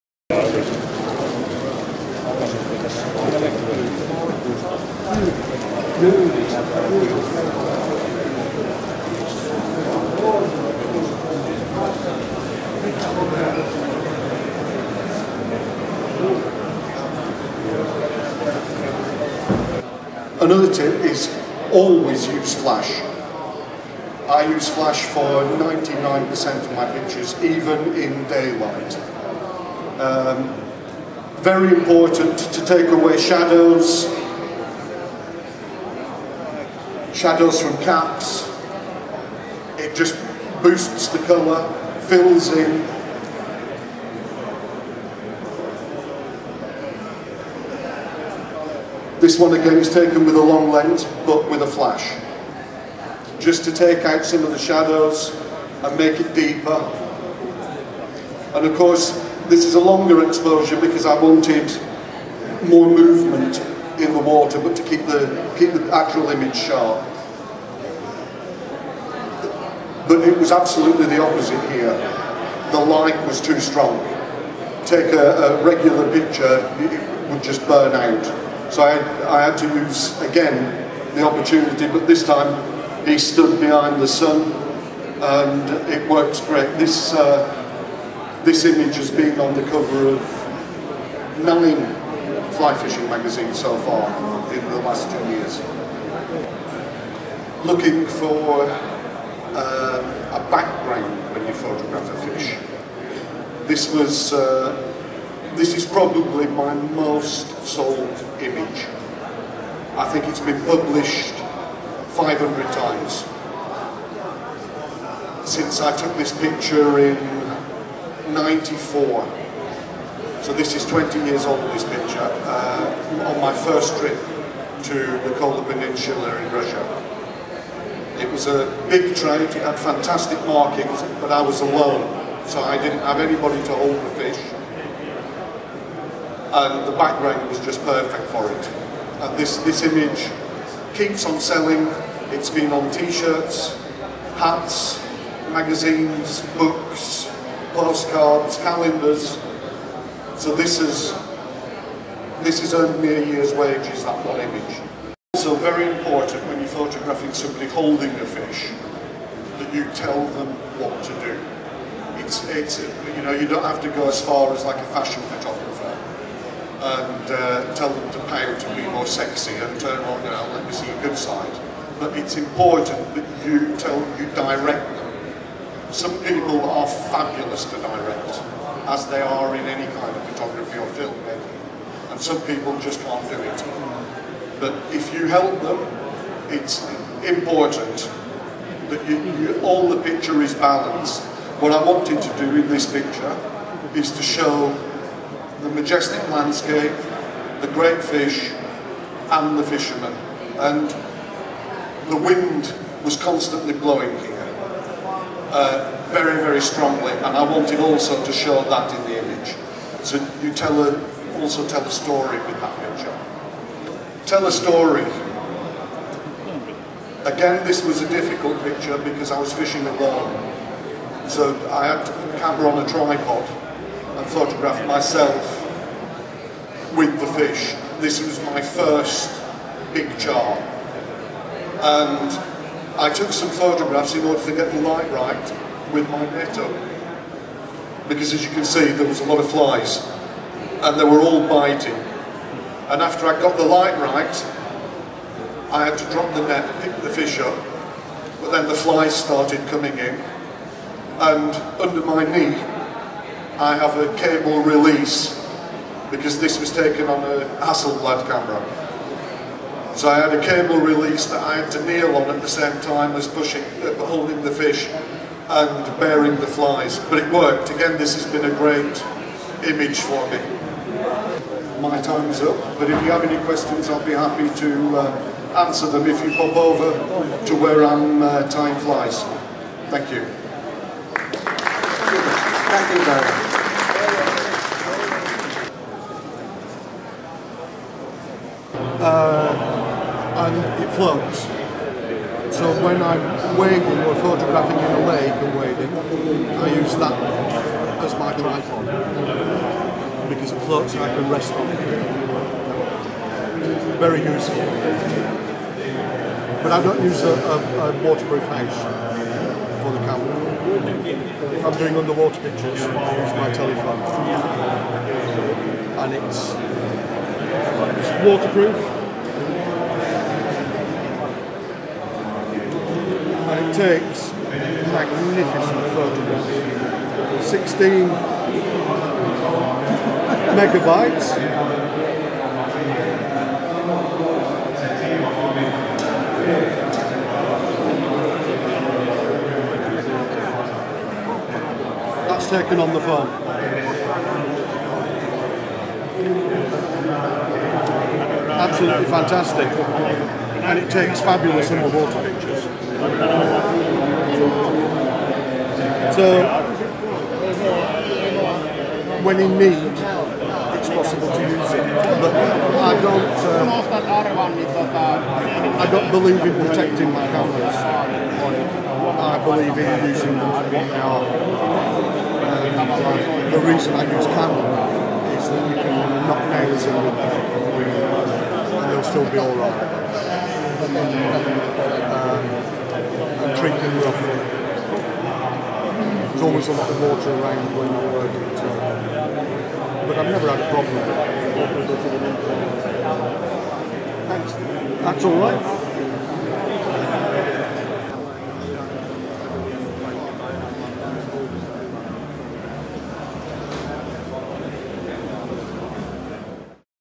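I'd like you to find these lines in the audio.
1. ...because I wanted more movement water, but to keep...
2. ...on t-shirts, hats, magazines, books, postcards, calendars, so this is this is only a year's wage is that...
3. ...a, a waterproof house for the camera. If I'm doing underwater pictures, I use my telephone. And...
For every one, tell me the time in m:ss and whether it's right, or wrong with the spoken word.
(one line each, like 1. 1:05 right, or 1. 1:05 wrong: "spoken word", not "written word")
1. 1:00 right
2. 2:22 right
3. 5:07 right.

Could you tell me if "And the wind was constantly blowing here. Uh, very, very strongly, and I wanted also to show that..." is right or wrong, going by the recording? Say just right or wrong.
right.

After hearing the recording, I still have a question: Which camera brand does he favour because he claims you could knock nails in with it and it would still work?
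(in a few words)
Canon.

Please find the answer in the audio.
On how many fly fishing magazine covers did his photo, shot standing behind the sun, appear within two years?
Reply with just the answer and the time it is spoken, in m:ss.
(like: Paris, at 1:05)
9, at 1:31.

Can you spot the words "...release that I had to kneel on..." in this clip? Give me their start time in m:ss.
4:20.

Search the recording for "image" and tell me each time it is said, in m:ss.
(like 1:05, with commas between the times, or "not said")
1:06, 1:28, 1:48, 2:19, 2:34, 3:29, 4:29.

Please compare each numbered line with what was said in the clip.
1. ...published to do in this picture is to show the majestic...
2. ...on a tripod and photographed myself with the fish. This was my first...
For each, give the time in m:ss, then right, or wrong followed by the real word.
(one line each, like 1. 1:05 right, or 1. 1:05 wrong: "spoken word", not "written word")
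1. 3:11 wrong: "wanted", not "published"
2. 3:42 right.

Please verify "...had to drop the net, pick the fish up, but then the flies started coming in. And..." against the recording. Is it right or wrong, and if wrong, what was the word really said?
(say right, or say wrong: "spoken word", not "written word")
right.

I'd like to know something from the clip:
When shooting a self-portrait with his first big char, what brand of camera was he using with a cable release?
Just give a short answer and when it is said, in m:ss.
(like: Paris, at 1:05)
Hasselblad, at 4:17.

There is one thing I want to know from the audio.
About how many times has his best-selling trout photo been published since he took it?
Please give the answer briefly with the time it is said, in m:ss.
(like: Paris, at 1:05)
500, at 1:52.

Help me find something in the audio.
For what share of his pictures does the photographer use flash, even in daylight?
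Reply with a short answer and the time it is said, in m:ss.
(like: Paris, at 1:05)
99%, at 0:25.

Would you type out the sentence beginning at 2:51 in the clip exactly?
But it's important that you tell you direct them.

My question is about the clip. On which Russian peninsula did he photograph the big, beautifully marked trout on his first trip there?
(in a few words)
Kola Peninsula.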